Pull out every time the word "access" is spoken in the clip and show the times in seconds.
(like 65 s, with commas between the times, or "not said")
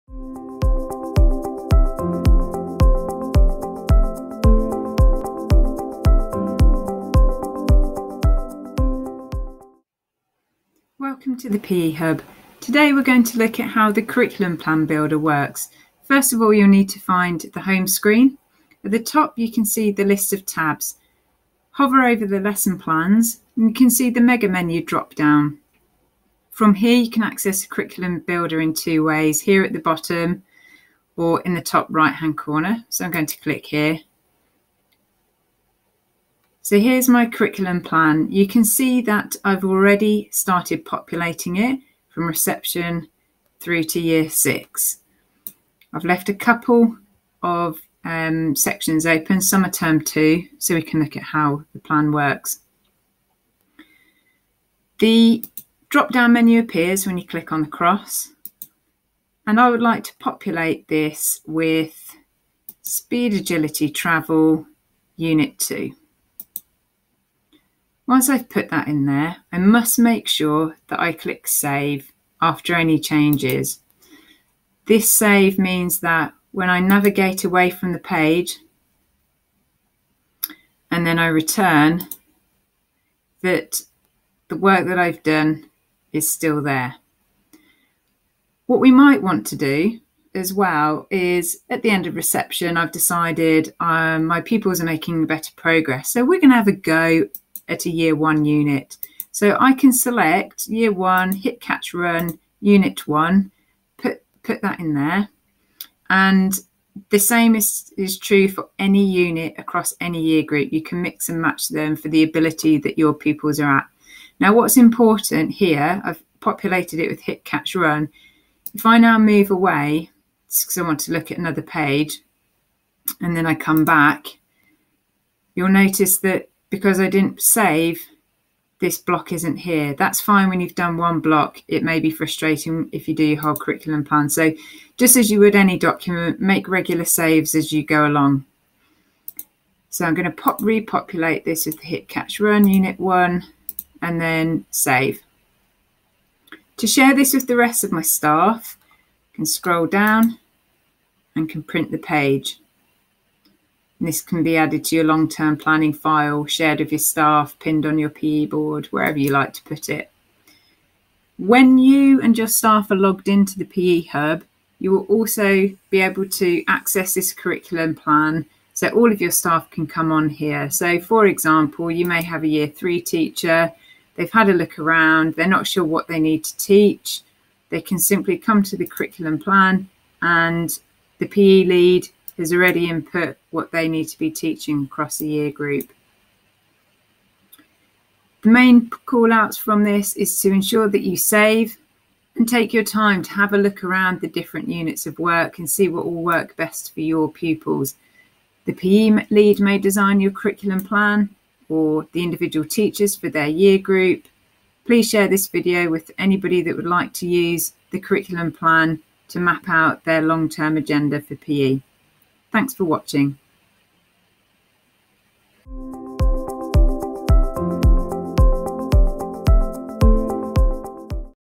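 27 s, 166 s.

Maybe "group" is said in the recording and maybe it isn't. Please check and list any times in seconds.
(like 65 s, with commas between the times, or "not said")
110 s, 185 s, 203 s.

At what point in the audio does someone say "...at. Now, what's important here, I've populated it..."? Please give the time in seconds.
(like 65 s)
113 s.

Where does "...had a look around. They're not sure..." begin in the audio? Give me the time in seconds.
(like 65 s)
174 s.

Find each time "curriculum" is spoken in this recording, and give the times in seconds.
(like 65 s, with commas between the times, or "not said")
14 s, 27 s, 37 s, 133 s, 167 s, 178 s, 200 s, 207 s.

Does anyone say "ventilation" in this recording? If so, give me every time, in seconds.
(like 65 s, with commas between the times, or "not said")
not said.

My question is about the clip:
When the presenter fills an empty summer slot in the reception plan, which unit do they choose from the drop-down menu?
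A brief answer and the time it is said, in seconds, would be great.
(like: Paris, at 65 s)
Speed agility travel unit 2, at 62 s.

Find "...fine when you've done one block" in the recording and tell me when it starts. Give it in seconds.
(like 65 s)
130 s.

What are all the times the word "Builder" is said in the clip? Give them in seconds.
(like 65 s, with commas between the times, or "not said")
14 s, 28 s.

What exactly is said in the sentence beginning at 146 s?
To share this with the rest of my staff, I can scroll down and can print the page.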